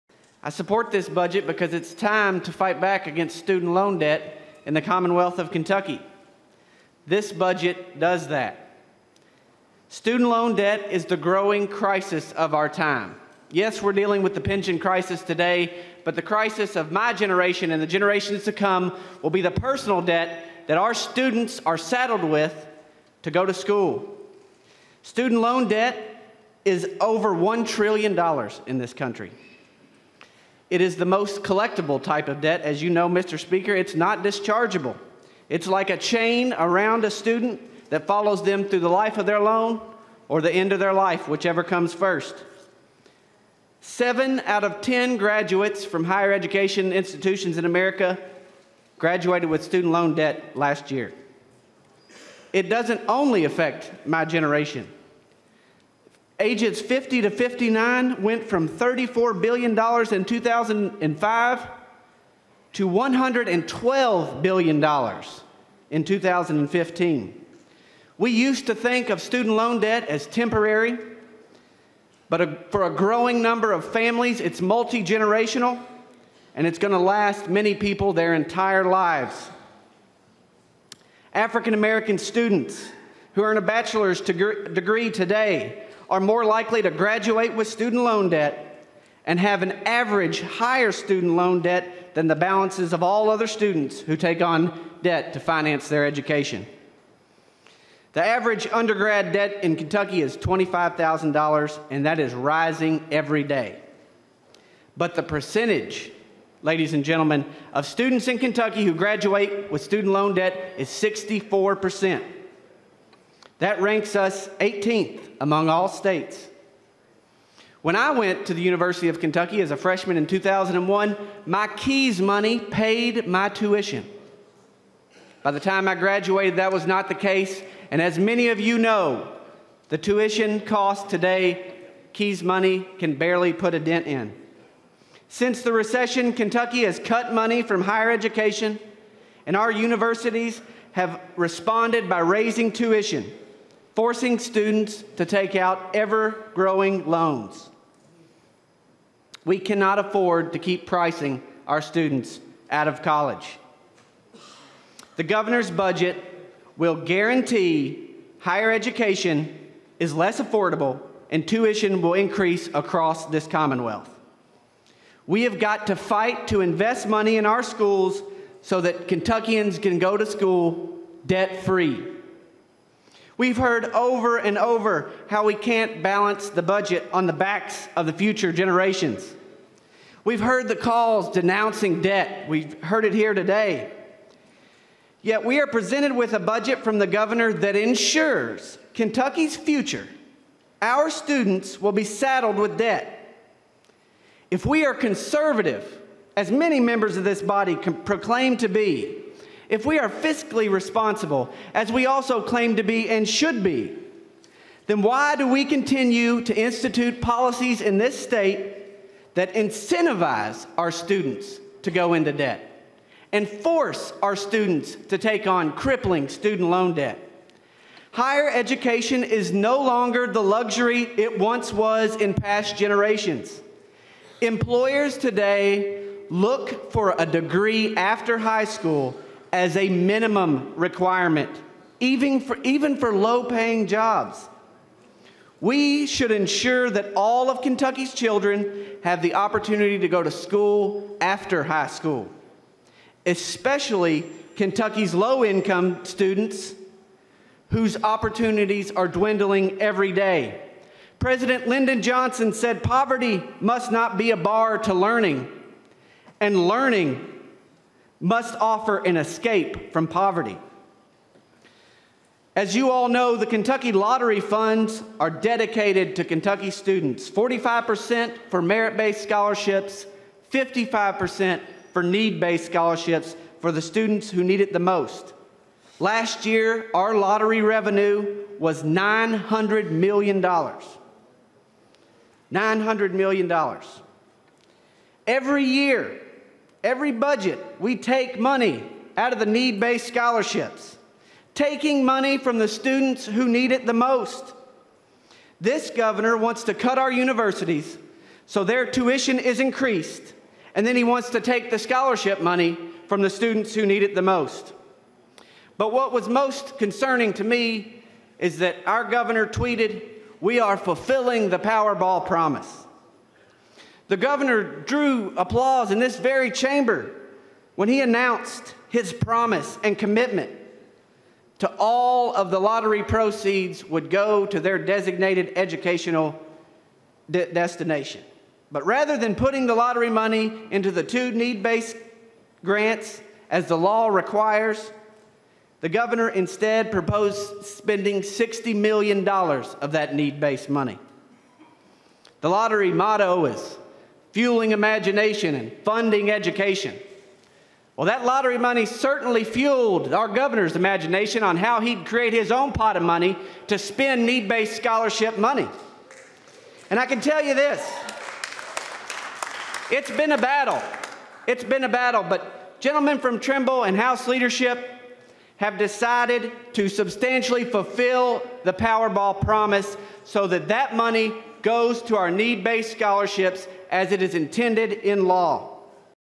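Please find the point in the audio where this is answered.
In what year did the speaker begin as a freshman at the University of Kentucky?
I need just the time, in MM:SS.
02:00.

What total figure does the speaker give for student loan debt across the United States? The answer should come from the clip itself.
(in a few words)
Over $1 trillion.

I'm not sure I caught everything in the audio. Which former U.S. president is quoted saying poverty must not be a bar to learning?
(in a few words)
Lyndon Johnson.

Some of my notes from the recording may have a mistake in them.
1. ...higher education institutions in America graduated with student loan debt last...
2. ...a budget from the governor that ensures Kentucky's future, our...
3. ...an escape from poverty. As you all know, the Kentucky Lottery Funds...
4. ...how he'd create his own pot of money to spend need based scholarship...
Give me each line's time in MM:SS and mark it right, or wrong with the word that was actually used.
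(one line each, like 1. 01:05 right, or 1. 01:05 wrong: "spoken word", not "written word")
1. 00:46 right
2. 03:06 right
3. 04:18 right
4. 05:51 right.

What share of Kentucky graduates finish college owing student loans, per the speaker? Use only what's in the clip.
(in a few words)
64 percent.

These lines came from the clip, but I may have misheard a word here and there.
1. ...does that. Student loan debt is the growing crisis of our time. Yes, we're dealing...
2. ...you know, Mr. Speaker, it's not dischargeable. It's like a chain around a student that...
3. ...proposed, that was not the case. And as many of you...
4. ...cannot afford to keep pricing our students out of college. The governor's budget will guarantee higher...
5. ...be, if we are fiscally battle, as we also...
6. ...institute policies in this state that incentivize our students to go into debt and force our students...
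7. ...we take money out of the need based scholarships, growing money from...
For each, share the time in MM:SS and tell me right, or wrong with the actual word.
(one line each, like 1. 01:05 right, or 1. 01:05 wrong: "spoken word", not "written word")
1. 00:07 right
2. 00:32 right
3. 02:05 wrong: "graduated", not "proposed"
4. 02:29 right
5. 03:18 wrong: "responsible", not "battle"
6. 03:26 right
7. 04:47 wrong: "taking", not "growing".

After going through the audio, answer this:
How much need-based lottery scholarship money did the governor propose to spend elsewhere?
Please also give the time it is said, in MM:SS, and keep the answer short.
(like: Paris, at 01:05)
$60 million, at 05:38.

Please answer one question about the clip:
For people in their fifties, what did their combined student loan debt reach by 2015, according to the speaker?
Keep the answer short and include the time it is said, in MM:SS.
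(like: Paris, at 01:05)
$112 billion, at 01:02.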